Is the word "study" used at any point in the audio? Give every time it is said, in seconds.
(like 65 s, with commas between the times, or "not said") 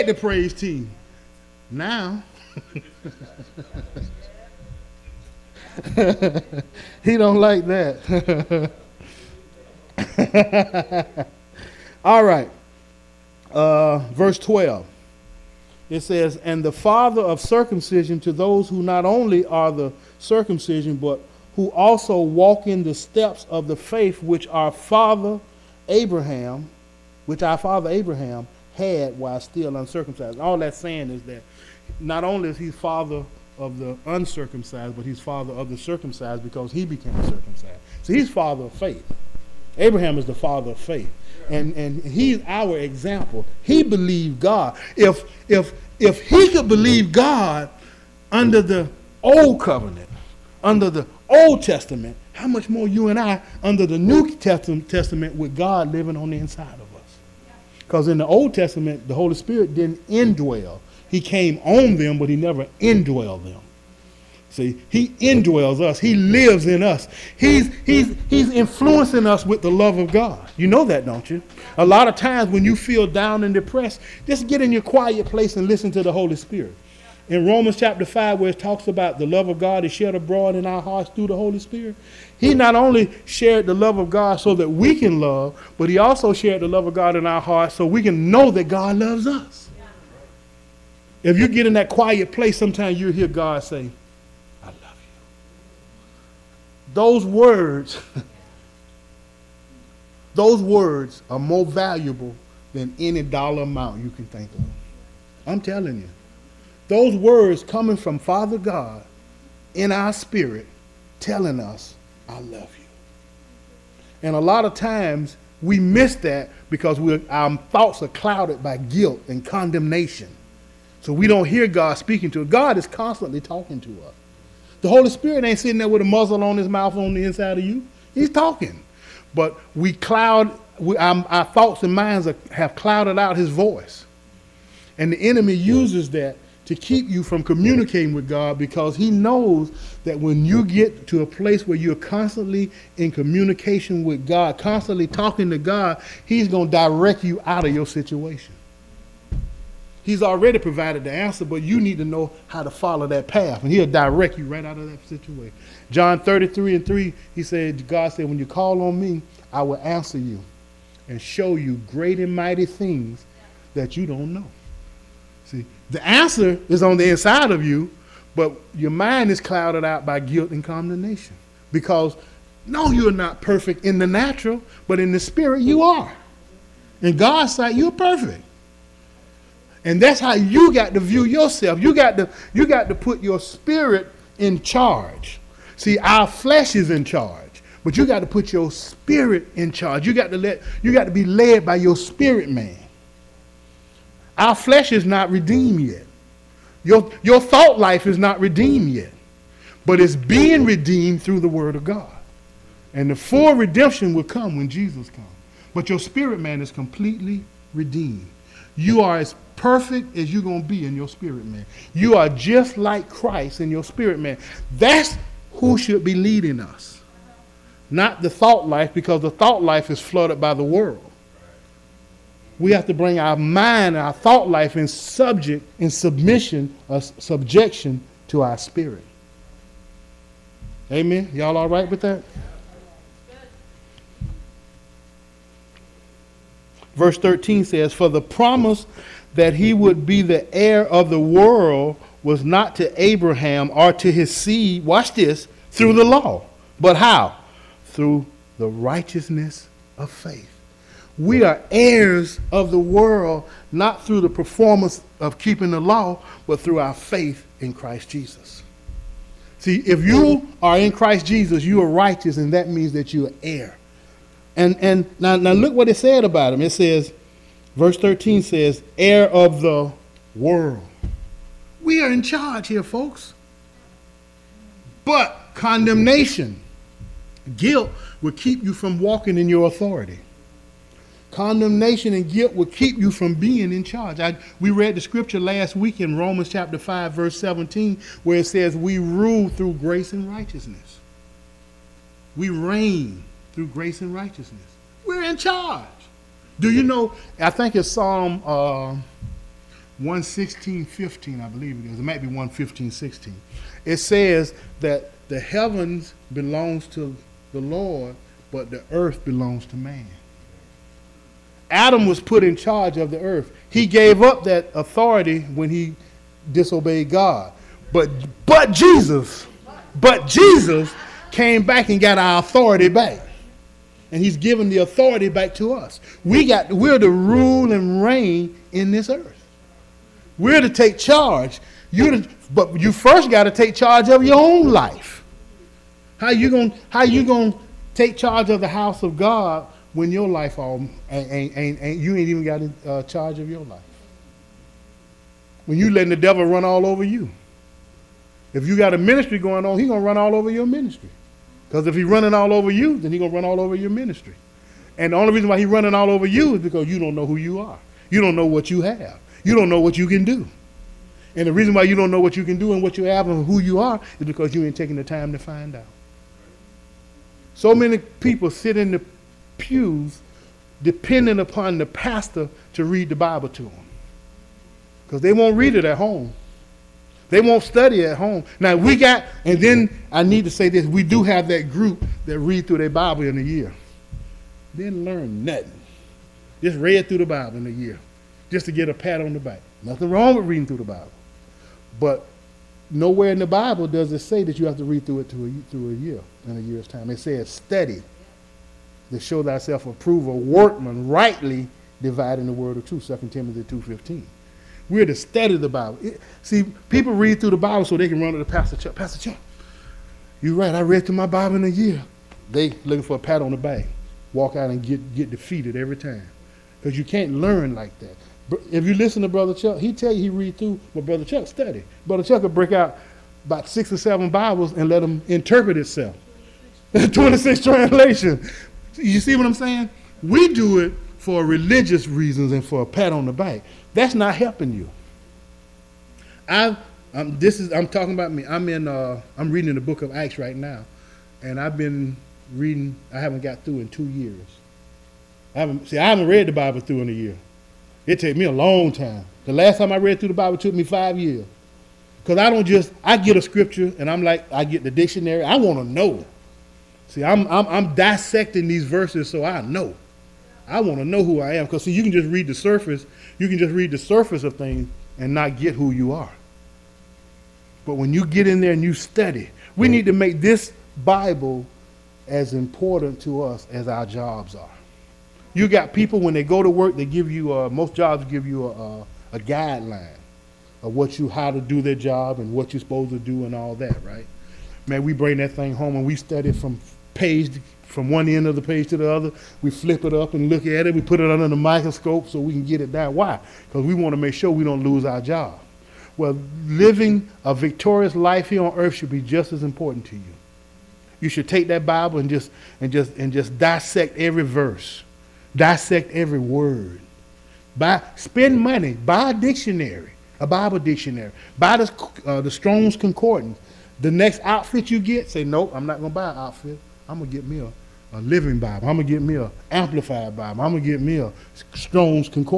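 377 s, 397 s, 405 s, 421 s, 468 s, 486 s.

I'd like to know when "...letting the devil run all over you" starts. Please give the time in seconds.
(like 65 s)
345 s.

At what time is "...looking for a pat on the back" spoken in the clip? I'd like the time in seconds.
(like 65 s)
412 s.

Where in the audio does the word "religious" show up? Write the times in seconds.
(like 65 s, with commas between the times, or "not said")
431 s.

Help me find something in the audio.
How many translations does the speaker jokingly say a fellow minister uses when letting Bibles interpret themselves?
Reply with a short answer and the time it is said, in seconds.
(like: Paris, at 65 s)
26, at 427 s.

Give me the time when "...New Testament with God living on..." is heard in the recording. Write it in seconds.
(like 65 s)
53 s.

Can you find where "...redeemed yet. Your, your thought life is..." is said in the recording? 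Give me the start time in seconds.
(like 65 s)
195 s.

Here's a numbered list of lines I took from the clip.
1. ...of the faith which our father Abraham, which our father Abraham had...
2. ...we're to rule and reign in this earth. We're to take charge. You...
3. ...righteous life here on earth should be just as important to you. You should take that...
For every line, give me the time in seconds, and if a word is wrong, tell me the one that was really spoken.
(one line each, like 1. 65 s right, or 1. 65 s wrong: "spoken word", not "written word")
1. 23 s right
2. 326 s right
3. 497 s wrong: "victorious", not "righteous".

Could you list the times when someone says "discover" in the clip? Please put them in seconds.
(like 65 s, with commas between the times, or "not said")
not said.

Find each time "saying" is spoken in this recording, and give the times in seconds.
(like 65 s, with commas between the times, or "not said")
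30 s, 429 s.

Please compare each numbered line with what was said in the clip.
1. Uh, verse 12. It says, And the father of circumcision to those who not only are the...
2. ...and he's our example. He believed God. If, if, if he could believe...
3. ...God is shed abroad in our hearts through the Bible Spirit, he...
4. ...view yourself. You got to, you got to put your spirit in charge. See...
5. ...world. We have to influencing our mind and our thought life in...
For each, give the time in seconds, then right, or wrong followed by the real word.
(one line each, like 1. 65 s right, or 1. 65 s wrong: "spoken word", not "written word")
1. 13 s right
2. 41 s right
3. 79 s wrong: "Holy", not "Bible"
4. 180 s right
5. 220 s wrong: "bring", not "influencing".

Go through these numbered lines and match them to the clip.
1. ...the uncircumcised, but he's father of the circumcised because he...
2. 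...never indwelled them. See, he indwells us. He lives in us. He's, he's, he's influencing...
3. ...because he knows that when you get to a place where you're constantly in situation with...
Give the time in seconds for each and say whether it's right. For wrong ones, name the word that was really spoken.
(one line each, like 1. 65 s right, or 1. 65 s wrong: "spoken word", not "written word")
1. 33 s right
2. 62 s right
3. 138 s wrong: "communication", not "situation".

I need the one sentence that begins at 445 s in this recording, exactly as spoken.
I haven't, see, I haven't read the Bible through in a year.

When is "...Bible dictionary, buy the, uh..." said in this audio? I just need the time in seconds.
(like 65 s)
510 s.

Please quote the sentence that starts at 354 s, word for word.
And the only reason why he's running all over you is because you don't know who you are.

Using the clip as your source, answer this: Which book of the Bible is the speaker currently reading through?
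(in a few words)
Acts.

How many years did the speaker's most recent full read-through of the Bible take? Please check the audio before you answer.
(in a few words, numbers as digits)
5 years.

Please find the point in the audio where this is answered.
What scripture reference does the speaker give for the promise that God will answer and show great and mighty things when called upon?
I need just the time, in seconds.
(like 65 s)
155 s.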